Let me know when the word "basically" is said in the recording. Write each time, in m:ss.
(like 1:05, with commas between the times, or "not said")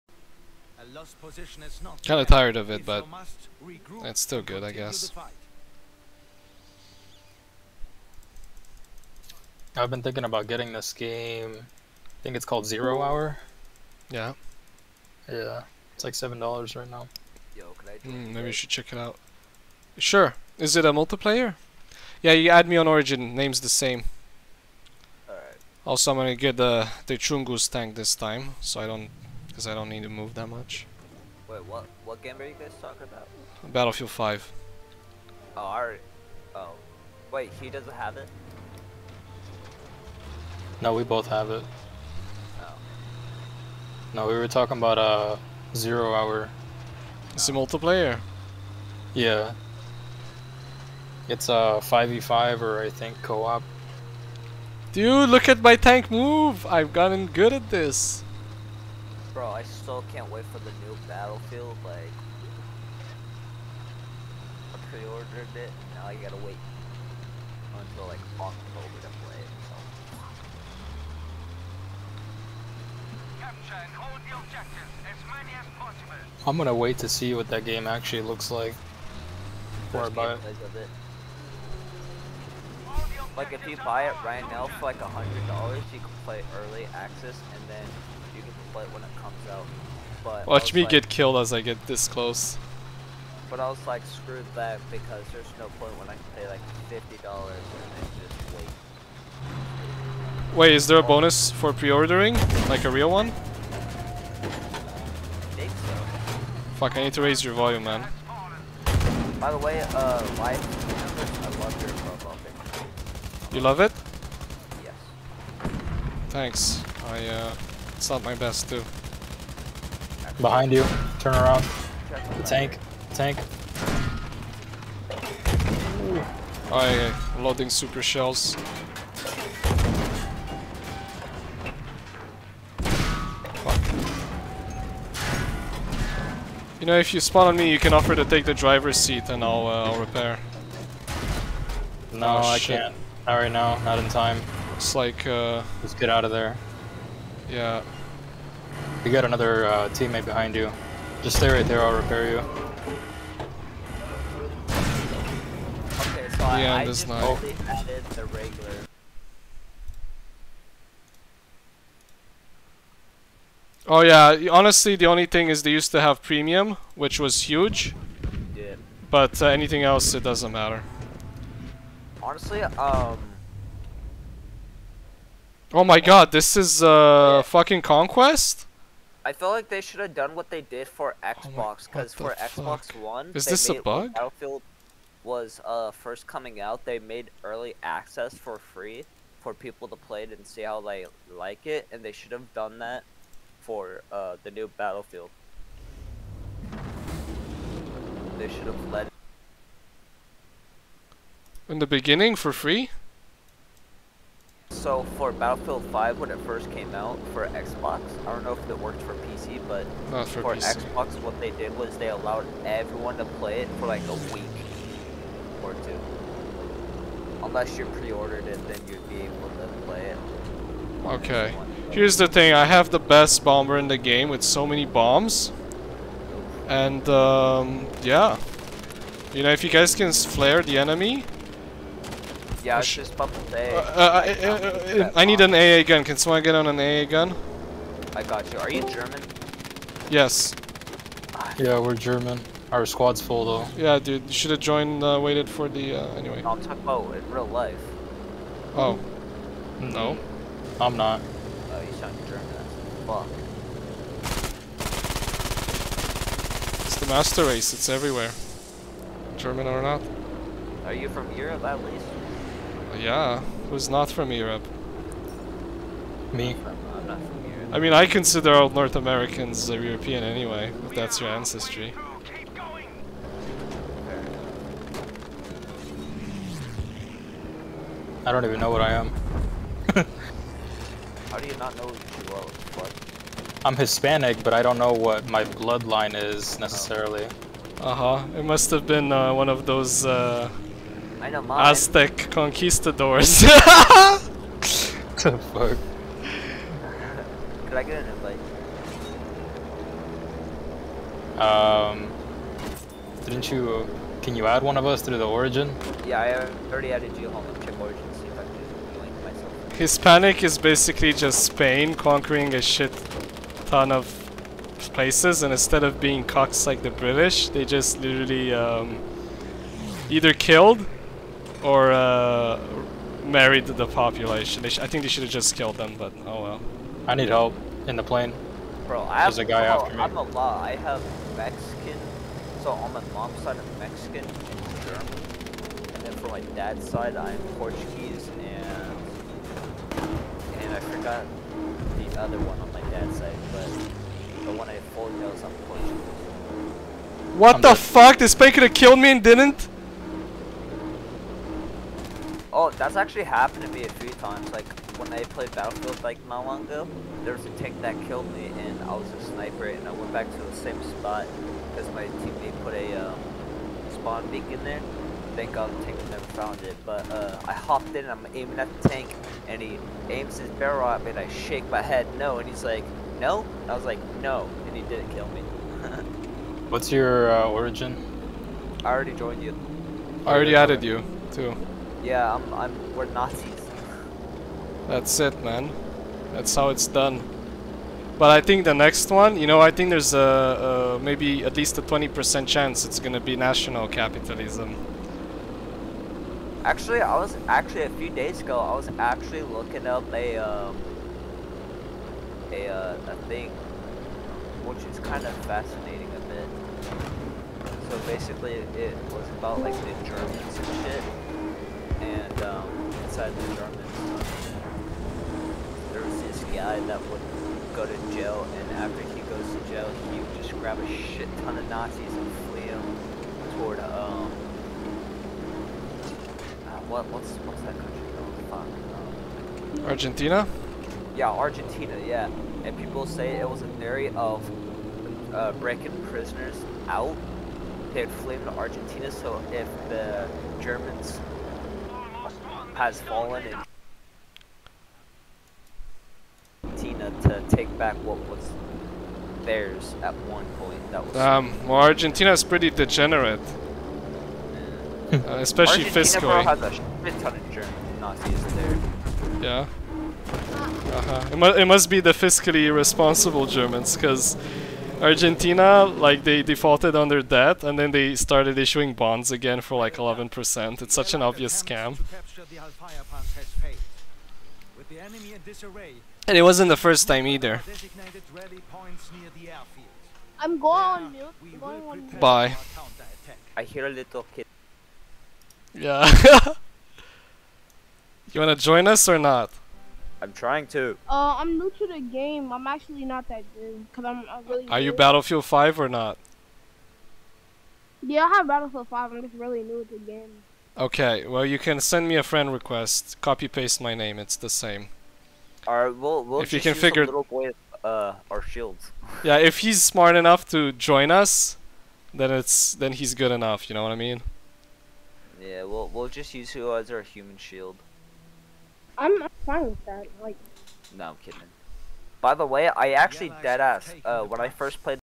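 5:10, 6:48.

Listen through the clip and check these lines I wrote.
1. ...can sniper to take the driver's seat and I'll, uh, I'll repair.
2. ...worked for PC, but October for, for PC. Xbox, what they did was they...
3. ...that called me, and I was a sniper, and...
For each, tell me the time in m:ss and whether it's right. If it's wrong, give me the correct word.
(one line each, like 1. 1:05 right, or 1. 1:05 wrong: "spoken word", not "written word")
1. 2:17 wrong: "offer", not "sniper"
2. 3:28 wrong: "Not", not "October"
3. 5:57 wrong: "killed", not "called".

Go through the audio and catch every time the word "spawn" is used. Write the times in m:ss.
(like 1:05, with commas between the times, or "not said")
2:17, 6:03.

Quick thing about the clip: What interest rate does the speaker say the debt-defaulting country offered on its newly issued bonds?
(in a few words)
11%.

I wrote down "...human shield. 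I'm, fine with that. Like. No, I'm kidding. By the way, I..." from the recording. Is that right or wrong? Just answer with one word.
right.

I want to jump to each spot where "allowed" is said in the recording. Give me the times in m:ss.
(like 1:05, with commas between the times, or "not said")
3:32.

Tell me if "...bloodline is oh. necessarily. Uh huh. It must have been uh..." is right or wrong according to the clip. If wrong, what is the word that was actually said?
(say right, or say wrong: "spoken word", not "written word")
right.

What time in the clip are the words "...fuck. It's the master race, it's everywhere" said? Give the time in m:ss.
4:13.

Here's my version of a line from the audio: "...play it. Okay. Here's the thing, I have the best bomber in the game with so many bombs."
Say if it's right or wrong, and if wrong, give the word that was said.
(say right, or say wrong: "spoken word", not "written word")
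right.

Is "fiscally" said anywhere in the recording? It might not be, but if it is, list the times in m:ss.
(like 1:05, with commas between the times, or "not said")
7:35, 7:42.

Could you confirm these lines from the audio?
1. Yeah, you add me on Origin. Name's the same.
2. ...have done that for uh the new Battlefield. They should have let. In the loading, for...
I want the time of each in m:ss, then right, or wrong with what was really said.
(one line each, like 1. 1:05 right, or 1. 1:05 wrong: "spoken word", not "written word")
1. 0:22 right
2. 3:12 wrong: "beginning", not "loading".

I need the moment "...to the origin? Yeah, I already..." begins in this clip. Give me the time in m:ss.
5:05.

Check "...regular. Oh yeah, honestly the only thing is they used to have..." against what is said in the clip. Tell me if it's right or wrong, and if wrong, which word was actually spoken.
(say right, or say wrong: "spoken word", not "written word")
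right.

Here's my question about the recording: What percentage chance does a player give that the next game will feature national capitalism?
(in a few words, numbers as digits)
20%.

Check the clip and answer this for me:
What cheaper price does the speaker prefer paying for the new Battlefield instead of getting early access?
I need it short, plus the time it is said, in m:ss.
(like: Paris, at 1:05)
$50, at 1:36.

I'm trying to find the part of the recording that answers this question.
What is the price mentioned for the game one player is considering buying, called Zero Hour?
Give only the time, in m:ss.
0:16.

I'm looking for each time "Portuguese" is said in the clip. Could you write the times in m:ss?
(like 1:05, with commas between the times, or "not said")
5:37, 5:45.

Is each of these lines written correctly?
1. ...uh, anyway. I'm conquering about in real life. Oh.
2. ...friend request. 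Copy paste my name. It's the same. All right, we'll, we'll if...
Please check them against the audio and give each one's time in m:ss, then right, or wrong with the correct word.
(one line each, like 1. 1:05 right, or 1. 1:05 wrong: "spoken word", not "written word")
1. 4:06 wrong: "talking", not "conquering"
2. 8:22 right.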